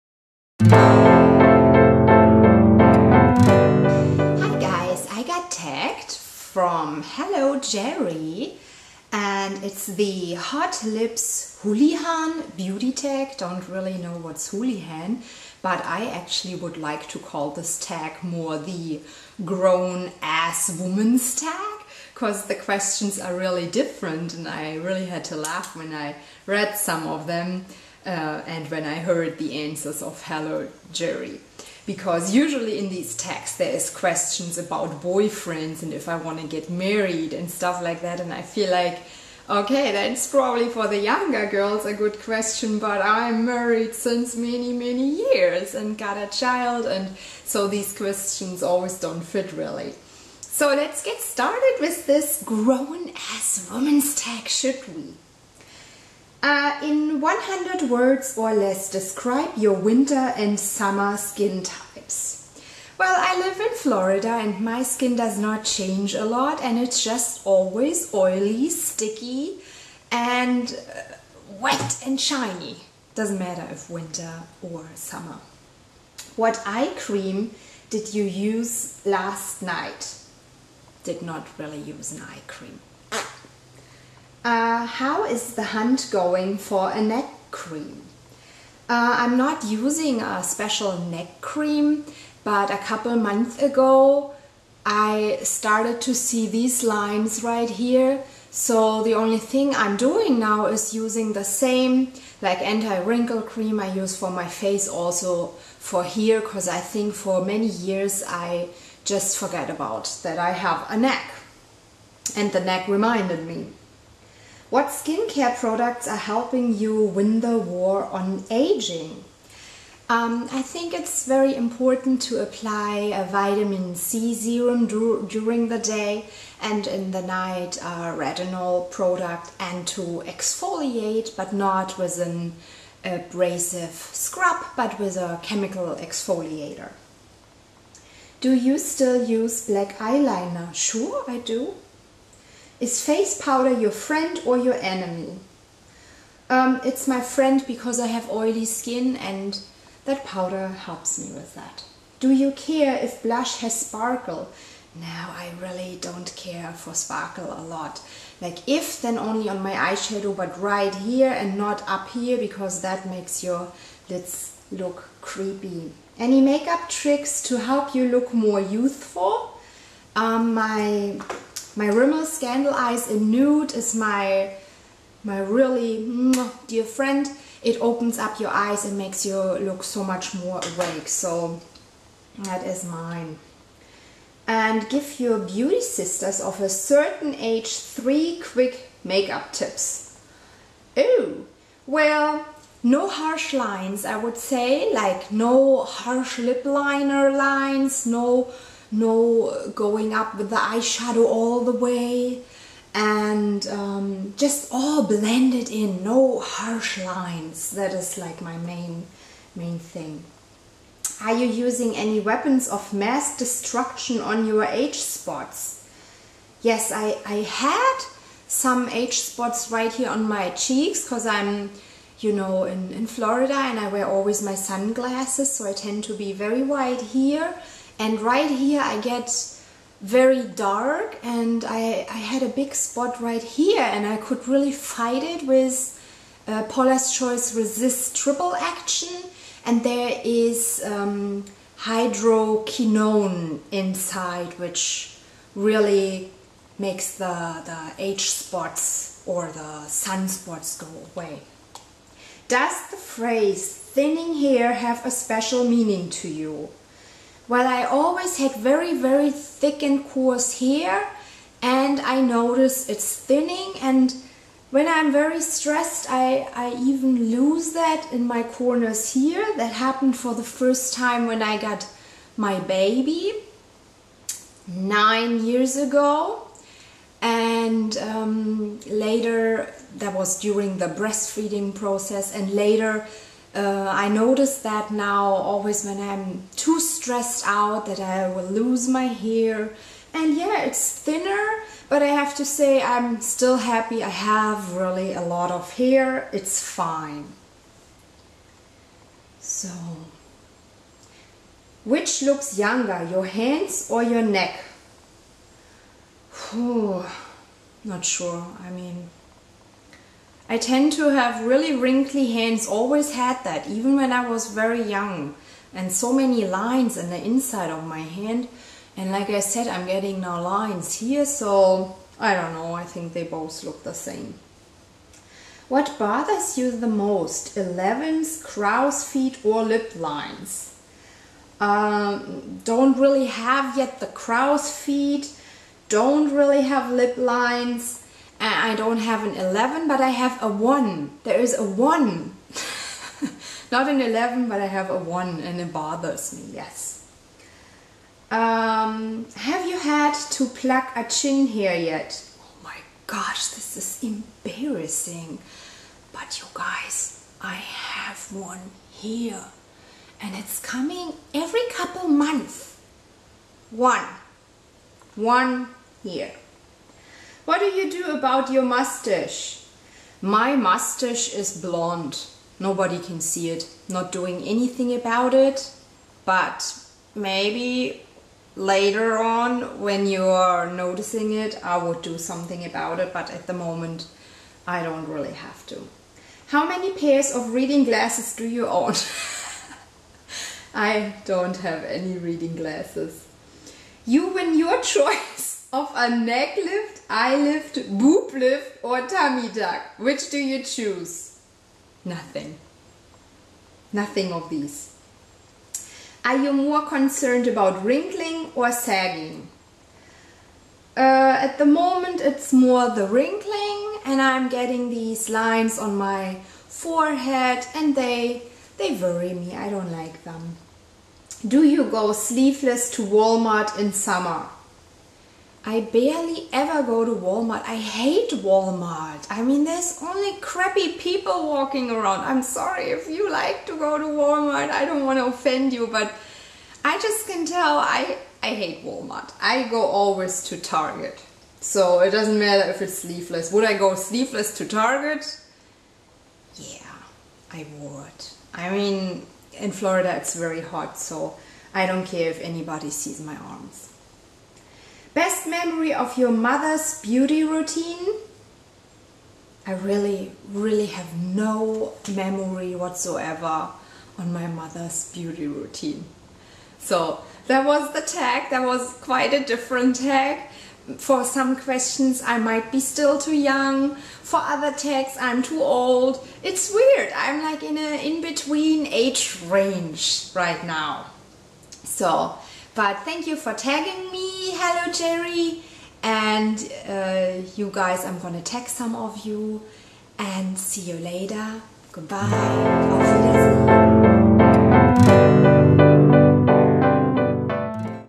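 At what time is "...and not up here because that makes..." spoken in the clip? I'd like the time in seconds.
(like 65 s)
161 s.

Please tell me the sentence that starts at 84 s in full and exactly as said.
Uh, how is the hunt going for a neck cream?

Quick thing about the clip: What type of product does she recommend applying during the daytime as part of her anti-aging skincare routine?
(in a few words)
Vitamin C serum.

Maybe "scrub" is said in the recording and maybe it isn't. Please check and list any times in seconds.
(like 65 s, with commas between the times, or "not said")
134 s.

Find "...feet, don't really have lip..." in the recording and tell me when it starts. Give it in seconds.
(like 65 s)
334 s.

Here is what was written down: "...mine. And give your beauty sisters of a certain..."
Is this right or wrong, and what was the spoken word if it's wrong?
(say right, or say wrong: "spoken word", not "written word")
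right.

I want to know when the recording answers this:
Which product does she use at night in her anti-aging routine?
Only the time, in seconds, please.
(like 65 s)
128 s.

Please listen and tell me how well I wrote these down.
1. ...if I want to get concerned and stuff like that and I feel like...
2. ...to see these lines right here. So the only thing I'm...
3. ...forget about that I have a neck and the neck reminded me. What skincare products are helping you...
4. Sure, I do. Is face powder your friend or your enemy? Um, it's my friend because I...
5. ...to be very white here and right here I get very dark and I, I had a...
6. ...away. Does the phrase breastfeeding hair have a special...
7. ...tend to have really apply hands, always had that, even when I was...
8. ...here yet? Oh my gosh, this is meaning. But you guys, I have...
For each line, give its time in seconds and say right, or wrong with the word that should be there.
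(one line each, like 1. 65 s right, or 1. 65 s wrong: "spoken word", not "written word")
1. 35 s wrong: "married", not "concerned"
2. 96 s right
3. 109 s right
4. 140 s right
5. 226 s right
6. 251 s wrong: "thinning", not "breastfeeding"
7. 310 s wrong: "wrinkly", not "apply"
8. 351 s wrong: "embarrassing", not "meaning".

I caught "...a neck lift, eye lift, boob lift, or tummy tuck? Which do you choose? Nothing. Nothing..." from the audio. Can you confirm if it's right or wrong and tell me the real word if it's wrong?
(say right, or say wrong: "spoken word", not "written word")
right.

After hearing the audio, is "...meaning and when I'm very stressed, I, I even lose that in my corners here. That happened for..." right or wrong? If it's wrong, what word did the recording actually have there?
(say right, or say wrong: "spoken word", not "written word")
wrong: "thinning", not "meaning".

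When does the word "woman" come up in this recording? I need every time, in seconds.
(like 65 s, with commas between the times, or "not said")
20 s, 53 s.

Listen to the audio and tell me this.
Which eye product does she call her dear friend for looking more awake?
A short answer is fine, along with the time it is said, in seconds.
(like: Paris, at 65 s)
Rimmel Scandal Eyes, at 171 s.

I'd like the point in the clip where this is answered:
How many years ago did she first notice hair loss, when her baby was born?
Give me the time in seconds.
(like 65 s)
274 s.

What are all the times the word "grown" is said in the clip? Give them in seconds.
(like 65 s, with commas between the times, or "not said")
19 s, 52 s.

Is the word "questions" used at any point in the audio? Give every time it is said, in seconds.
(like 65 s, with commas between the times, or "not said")
22 s, 33 s, 42 s, 47 s, 471 s.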